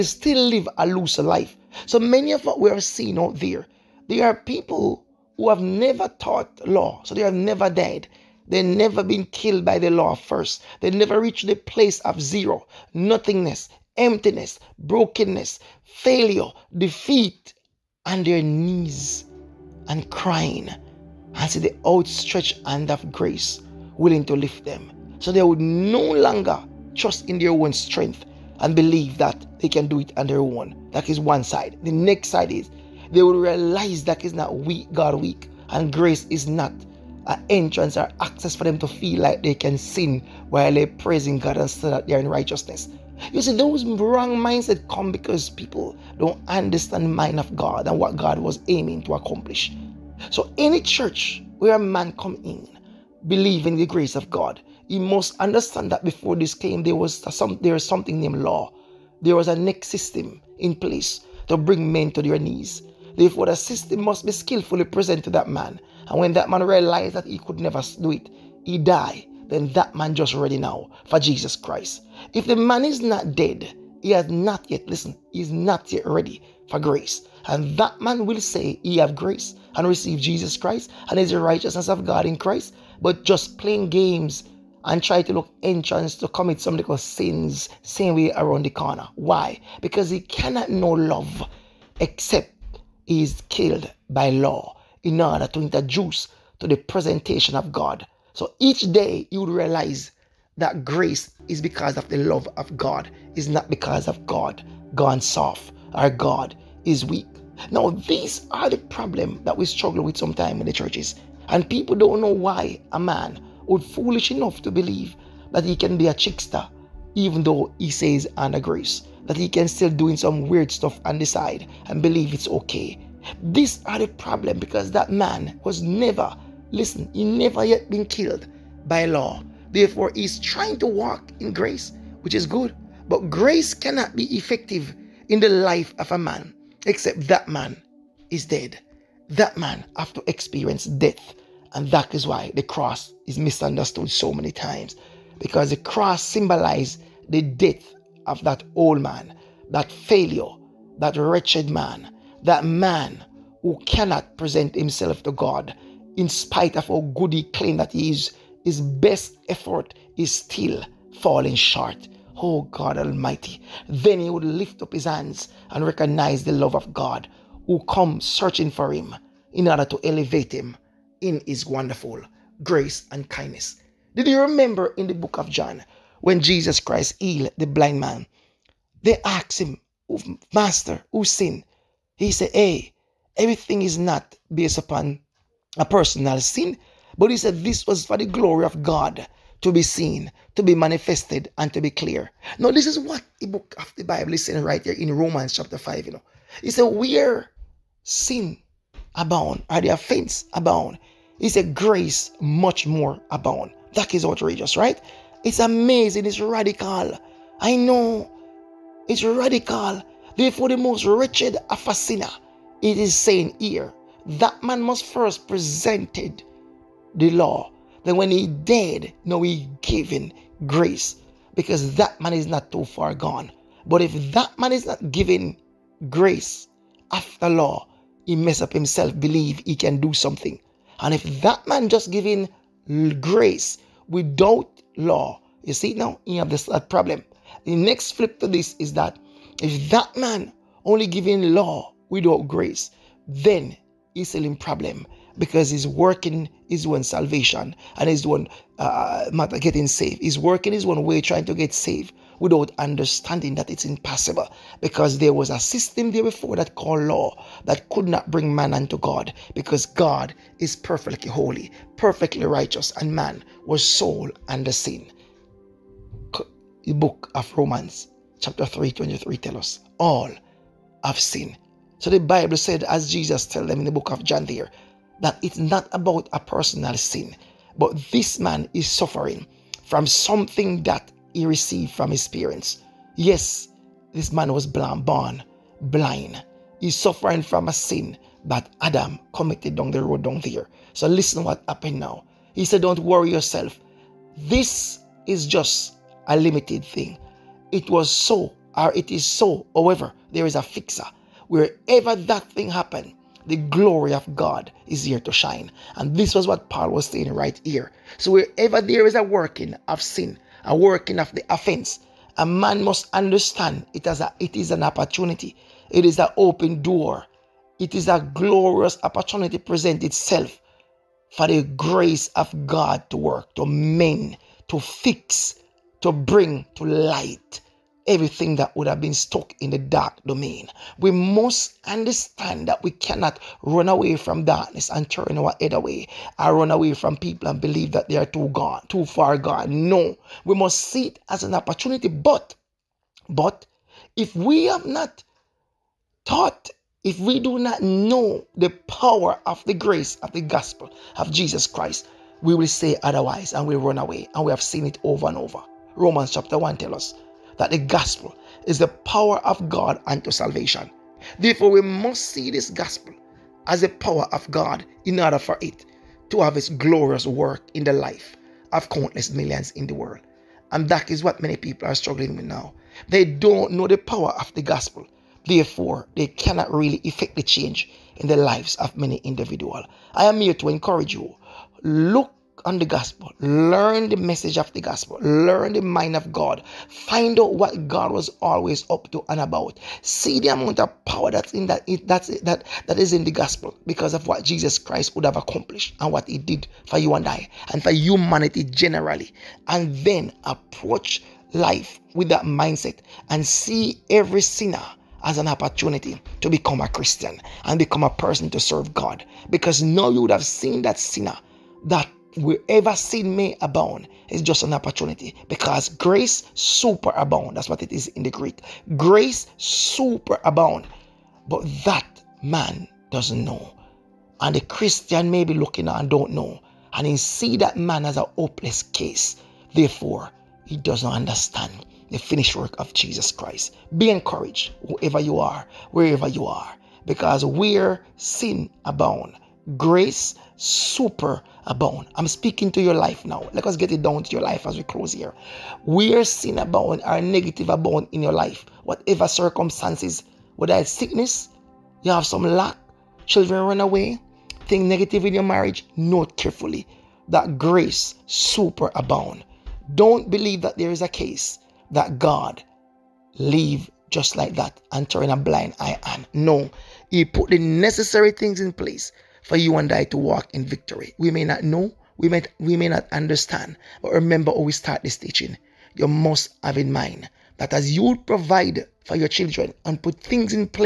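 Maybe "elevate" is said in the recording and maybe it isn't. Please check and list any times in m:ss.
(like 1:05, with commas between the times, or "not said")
2:50.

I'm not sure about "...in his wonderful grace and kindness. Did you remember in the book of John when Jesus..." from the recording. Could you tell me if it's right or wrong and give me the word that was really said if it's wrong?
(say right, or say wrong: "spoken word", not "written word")
right.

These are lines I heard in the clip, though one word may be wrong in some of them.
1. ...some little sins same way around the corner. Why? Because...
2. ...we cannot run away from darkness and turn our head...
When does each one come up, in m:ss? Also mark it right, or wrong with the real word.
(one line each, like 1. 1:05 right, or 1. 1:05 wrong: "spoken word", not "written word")
1. 1:26 right
2. 5:32 right.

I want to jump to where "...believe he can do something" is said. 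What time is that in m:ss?
3:49.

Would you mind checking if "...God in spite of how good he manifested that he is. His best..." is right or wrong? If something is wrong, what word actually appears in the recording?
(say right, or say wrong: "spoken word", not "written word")
wrong: "claimed", not "manifested".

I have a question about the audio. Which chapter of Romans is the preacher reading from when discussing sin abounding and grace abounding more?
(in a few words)
Romans chapter 5.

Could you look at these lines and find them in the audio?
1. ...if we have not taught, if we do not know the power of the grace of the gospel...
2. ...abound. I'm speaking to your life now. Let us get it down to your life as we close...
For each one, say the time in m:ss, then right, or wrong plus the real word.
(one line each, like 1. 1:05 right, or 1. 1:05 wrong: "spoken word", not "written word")
1. 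5:44 right
2. 7:21 right.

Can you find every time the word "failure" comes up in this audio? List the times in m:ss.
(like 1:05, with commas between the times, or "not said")
0:15, 2:29.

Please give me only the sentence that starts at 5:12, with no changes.
A man must understand it, as a, it is an opportunity.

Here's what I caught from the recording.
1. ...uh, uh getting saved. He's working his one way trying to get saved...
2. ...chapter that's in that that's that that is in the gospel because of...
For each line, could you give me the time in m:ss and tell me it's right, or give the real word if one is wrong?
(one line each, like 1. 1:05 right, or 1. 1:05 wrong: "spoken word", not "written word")
1. 4:08 right
2. 6:31 wrong: "power", not "chapter".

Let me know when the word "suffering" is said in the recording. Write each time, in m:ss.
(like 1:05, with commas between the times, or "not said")
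4:38, 4:46.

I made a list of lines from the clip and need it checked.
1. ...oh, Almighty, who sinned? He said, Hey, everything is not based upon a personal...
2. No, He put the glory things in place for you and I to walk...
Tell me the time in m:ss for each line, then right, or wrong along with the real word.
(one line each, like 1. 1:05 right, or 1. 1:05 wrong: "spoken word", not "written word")
1. 3:00 wrong: "Master", not "Almighty"
2. 7:46 wrong: "necessary", not "glory".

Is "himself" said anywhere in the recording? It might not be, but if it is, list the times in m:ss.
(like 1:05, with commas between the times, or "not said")
2:34, 3:48.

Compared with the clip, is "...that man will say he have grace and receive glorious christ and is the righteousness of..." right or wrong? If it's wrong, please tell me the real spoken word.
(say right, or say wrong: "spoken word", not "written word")
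wrong: "jesus", not "glorious".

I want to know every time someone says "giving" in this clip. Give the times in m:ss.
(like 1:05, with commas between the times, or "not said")
3:52, 4:01.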